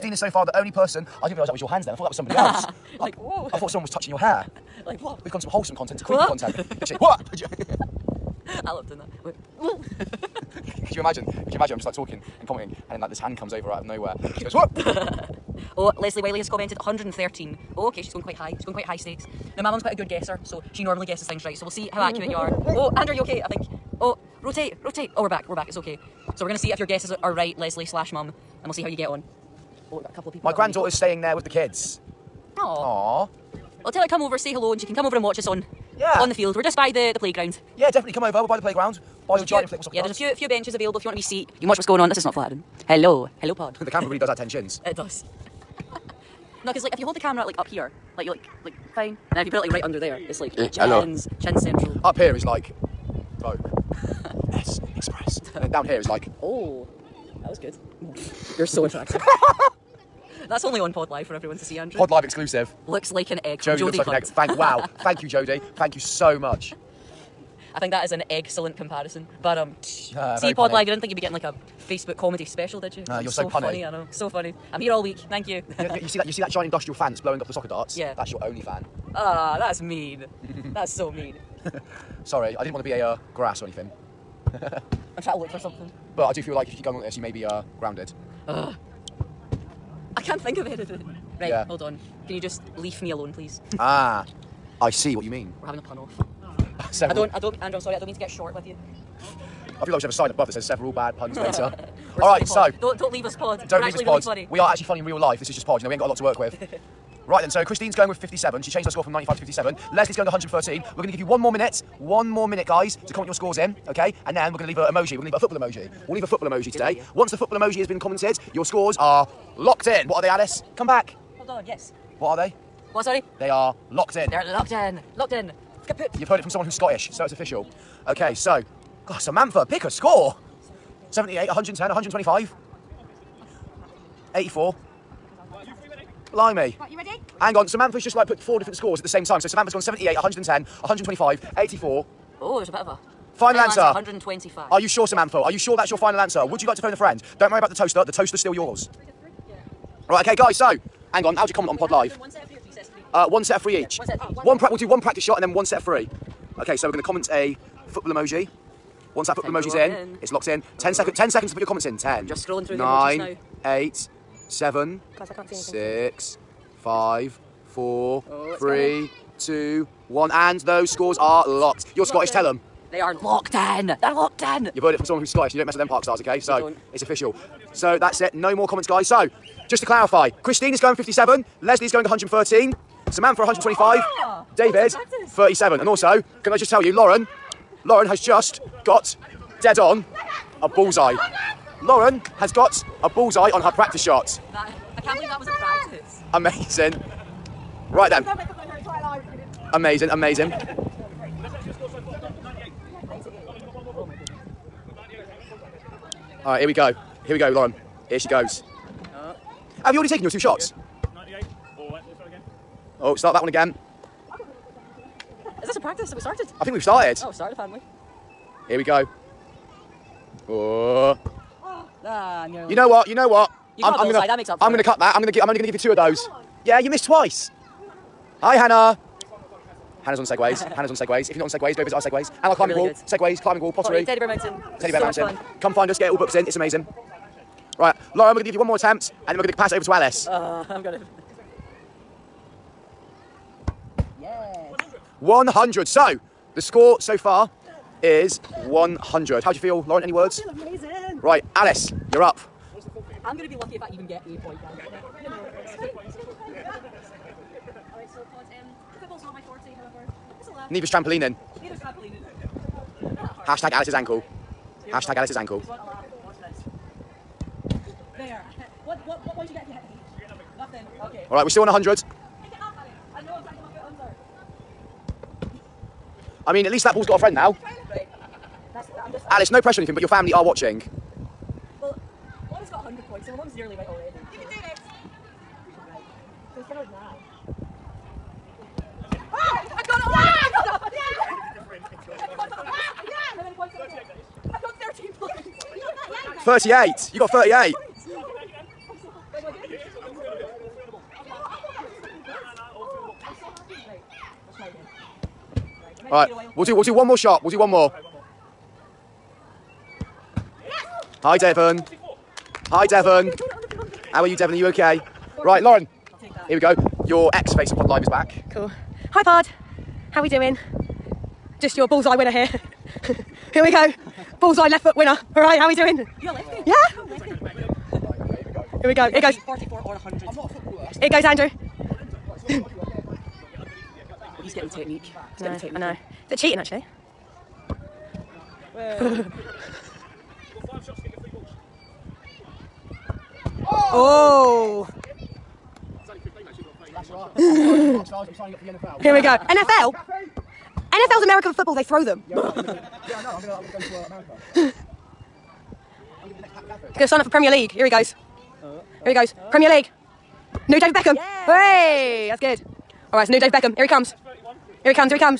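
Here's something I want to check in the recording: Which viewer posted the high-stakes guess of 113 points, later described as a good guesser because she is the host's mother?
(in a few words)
Leslie Wiley.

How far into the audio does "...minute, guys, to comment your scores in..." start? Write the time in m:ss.
1:52.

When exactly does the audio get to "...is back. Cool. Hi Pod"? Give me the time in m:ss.
5:18.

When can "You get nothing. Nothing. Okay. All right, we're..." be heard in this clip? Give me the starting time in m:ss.
4:30.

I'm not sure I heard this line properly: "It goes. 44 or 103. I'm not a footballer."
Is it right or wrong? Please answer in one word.
wrong.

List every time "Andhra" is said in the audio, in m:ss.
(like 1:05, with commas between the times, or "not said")
not said.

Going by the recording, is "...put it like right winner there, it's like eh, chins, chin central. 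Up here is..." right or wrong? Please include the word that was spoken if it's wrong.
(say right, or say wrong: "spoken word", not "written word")
wrong: "under", not "winner".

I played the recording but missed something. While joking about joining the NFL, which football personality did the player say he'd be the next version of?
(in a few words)
Pat McAfee.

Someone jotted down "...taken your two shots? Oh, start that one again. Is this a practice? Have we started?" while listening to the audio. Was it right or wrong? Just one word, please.
right.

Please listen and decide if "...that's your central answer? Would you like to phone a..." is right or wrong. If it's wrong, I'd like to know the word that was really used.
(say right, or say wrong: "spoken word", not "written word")
wrong: "final", not "central".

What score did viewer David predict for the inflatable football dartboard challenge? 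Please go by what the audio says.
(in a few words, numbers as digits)
37.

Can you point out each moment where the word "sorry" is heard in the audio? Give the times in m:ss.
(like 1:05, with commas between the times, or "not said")
1:22, 1:37, 2:03.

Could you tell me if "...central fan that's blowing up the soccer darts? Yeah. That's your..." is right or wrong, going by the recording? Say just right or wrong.
wrong.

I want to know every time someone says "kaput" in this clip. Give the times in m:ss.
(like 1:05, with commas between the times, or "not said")
2:05.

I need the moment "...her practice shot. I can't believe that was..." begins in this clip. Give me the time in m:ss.
3:13.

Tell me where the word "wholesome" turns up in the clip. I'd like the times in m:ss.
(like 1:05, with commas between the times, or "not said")
0:05.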